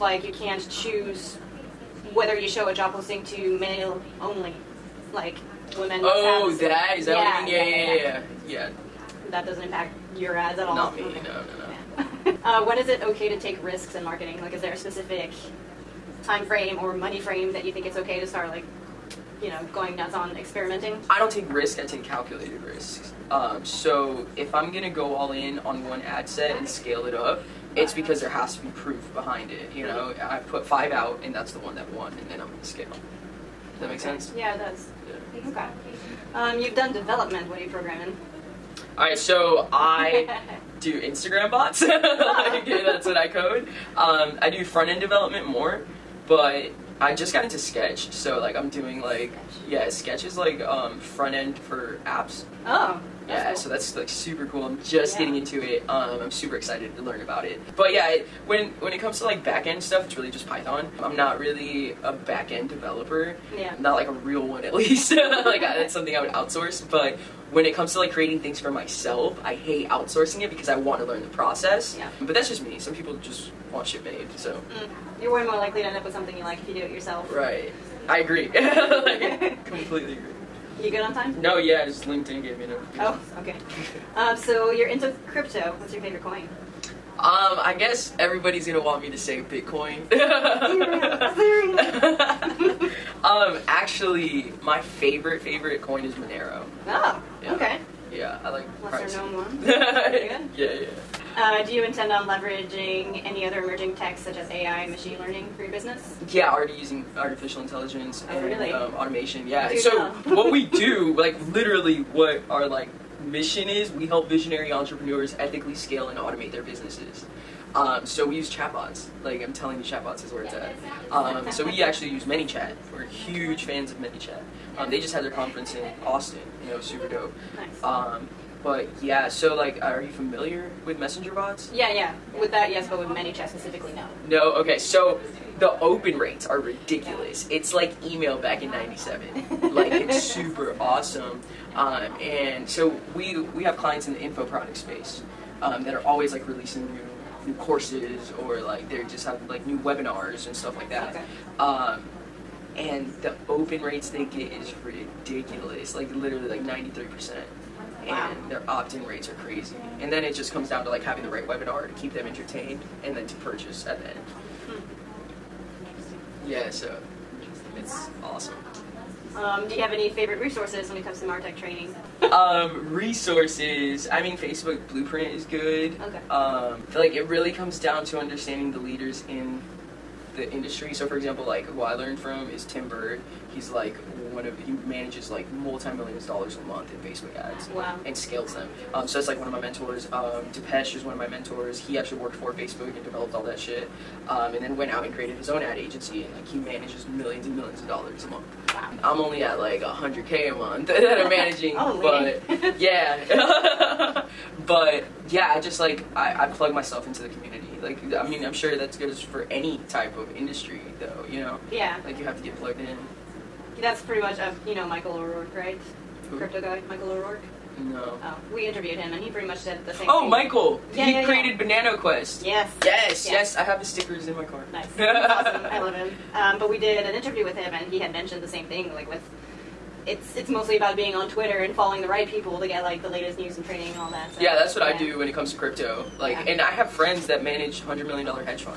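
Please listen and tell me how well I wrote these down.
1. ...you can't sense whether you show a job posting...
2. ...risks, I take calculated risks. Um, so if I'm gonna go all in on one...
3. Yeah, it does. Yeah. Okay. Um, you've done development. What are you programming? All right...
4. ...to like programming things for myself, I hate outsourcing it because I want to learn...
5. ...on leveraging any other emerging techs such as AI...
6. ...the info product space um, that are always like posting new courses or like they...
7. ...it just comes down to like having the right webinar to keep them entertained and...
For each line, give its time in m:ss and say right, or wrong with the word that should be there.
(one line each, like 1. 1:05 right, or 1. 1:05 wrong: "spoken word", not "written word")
1. 0:00 wrong: "choose", not "sense"
2. 0:21 right
3. 0:34 right
4. 1:07 wrong: "creating", not "programming"
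5. 1:42 right
6. 2:24 wrong: "releasing", not "posting"
7. 2:40 right.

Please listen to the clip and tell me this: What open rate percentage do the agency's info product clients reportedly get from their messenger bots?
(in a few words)
93 percent.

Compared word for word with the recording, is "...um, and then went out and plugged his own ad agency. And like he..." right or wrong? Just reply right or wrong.
wrong.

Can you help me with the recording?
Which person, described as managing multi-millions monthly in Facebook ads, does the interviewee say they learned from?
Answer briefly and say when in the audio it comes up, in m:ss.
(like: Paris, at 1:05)
Tim Burd, at 3:02.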